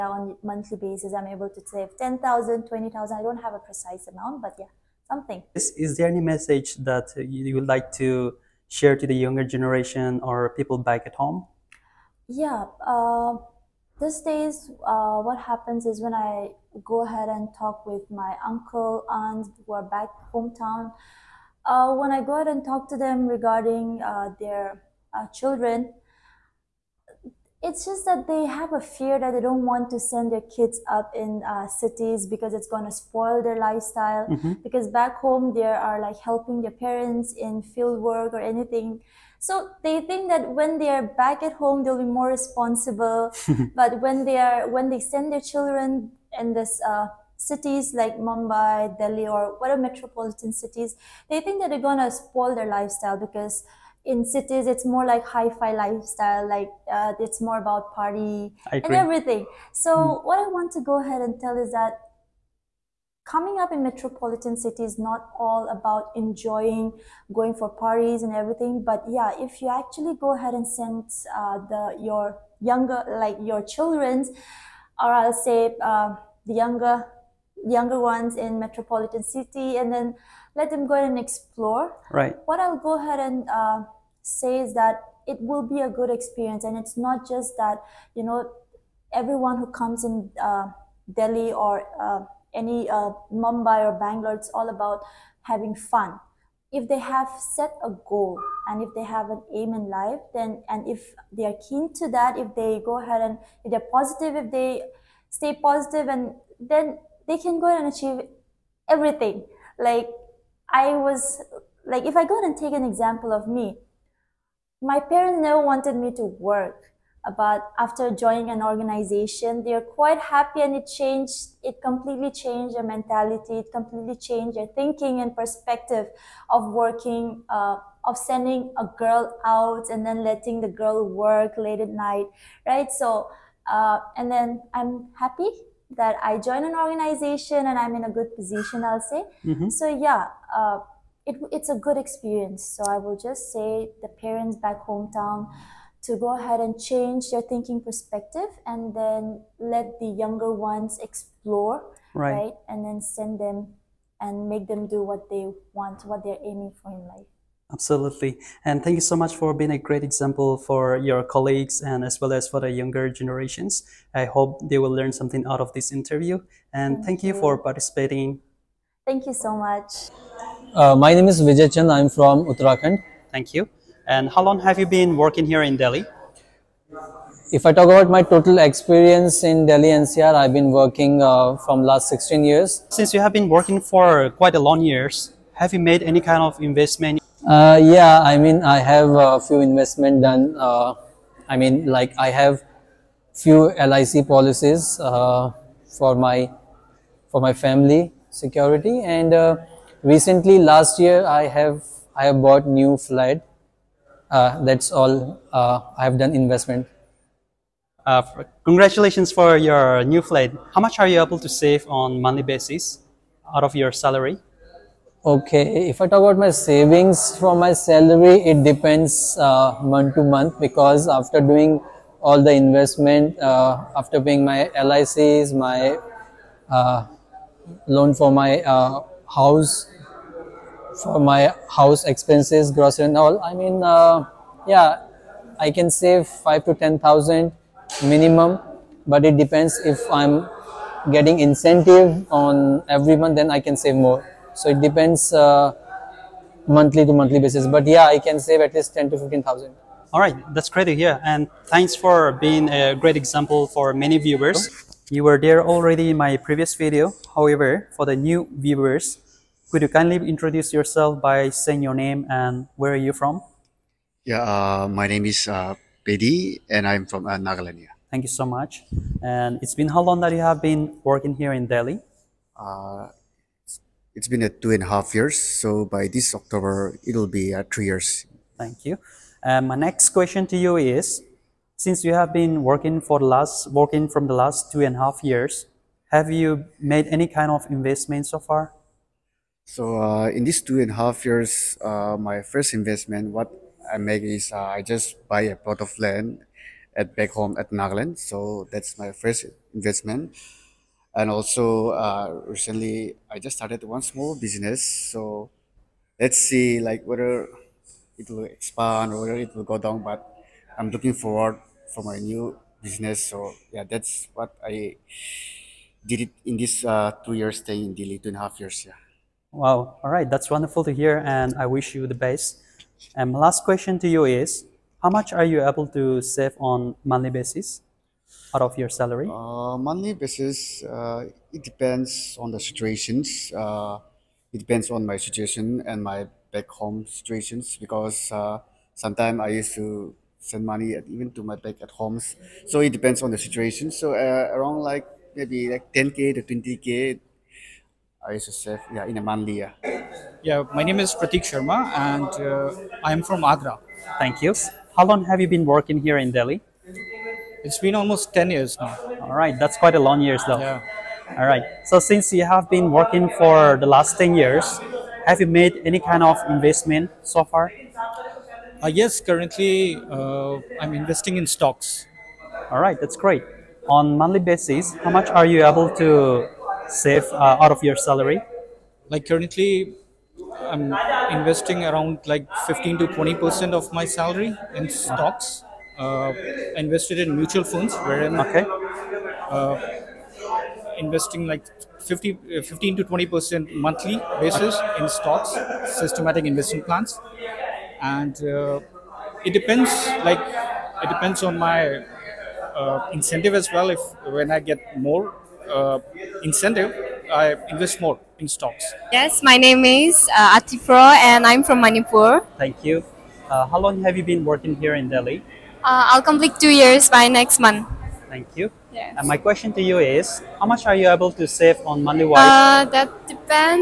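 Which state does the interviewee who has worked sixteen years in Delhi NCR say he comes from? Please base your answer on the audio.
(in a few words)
Uttarakhand.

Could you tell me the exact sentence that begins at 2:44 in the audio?
I hope they will learn something out of this interview.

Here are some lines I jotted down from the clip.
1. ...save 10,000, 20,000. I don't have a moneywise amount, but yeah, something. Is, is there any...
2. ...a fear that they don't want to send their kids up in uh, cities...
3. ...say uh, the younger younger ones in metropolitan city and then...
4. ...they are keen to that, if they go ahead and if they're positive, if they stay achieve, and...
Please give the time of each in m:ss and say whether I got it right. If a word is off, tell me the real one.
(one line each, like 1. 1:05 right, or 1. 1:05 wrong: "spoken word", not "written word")
1. 0:01 wrong: "precise", not "moneywise"
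2. 0:28 right
3. 1:15 right
4. 1:41 wrong: "positive", not "achieve".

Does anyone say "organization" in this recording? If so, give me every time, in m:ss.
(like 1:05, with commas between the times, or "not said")
1:58, 2:16.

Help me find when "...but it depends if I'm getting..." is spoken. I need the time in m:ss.
3:59.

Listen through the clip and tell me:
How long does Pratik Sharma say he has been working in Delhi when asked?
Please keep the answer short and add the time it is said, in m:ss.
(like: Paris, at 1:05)
almost 10 years, at 5:57.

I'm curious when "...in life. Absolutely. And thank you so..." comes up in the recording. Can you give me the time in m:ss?
2:36.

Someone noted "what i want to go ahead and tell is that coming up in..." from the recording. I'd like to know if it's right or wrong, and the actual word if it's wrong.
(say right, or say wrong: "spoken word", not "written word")
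right.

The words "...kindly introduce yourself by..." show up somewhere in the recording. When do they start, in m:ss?
4:19.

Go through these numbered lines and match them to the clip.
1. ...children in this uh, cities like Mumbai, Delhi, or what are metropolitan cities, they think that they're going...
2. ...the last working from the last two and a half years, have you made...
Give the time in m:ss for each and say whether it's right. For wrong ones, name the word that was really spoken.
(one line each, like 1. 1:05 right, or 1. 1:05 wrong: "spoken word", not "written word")
1. 0:45 right
2. 4:43 right.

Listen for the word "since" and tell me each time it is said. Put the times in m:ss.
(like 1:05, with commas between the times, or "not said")
3:02, 4:41, 6:01.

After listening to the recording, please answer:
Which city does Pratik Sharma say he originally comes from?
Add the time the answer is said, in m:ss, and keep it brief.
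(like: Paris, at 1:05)
Agra, at 5:53.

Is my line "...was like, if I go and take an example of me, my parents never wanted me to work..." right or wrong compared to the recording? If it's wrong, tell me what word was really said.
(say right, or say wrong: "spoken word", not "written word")
right.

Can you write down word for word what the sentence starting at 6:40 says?
Like it depends on my uh, incentive as well.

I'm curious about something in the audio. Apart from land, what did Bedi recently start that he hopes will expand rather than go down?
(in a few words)
small business.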